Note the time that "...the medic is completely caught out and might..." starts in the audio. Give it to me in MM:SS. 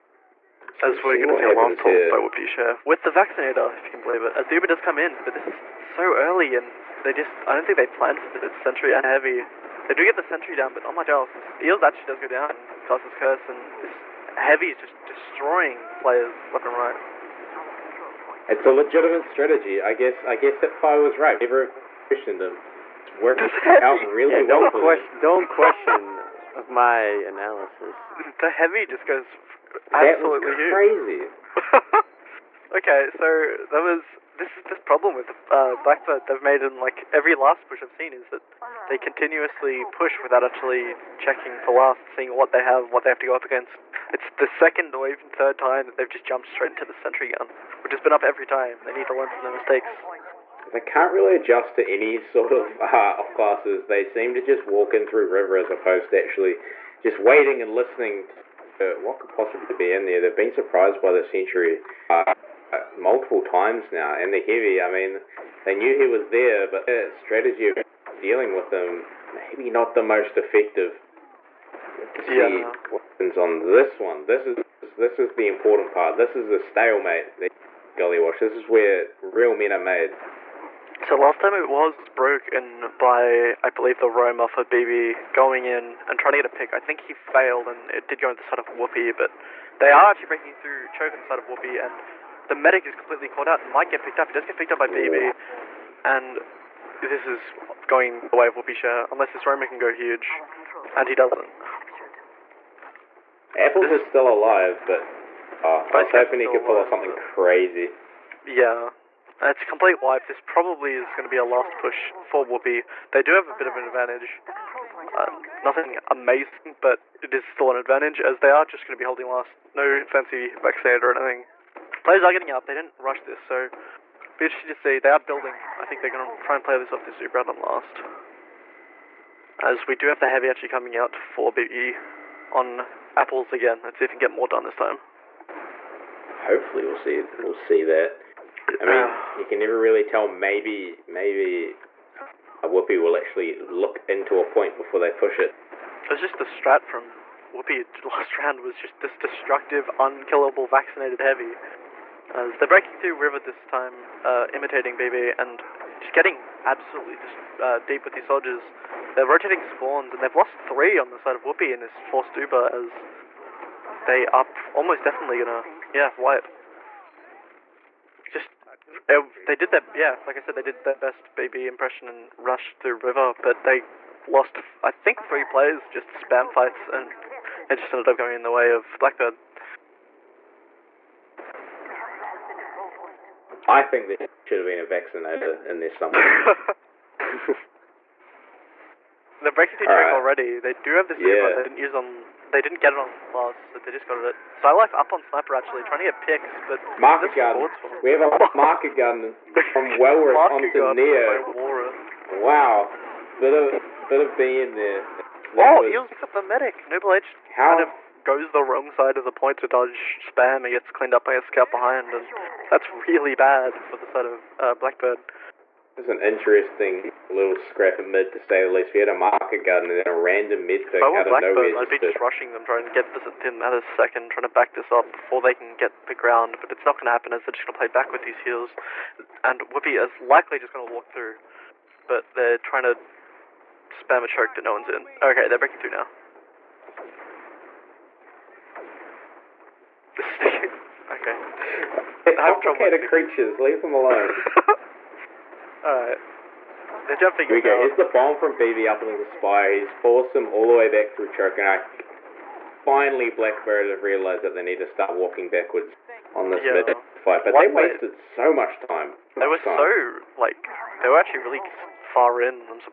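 01:32.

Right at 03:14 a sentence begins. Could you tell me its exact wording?
So i Stylife up on sniper actually, trying to get picks, but market garden.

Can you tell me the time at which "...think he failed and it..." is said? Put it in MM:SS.
01:26.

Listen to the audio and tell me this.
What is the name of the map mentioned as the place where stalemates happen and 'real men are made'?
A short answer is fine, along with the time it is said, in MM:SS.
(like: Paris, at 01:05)
Gullywash, at 01:18.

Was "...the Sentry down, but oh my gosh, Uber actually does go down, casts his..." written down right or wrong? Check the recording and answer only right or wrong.
wrong.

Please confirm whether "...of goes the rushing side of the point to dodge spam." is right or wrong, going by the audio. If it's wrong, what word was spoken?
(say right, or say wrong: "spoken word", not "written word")
wrong: "wrong", not "rushing".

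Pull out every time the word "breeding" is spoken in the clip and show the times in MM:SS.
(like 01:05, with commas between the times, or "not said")
not said.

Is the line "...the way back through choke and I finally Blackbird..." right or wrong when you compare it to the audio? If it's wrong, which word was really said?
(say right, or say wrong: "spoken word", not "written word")
right.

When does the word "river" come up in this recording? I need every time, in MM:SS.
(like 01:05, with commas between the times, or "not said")
00:55, 02:33, 02:52.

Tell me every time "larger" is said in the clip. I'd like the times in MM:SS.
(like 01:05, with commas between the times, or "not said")
not said.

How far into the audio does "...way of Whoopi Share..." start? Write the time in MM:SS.
01:38.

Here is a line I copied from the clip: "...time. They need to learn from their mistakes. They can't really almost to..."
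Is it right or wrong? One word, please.
wrong.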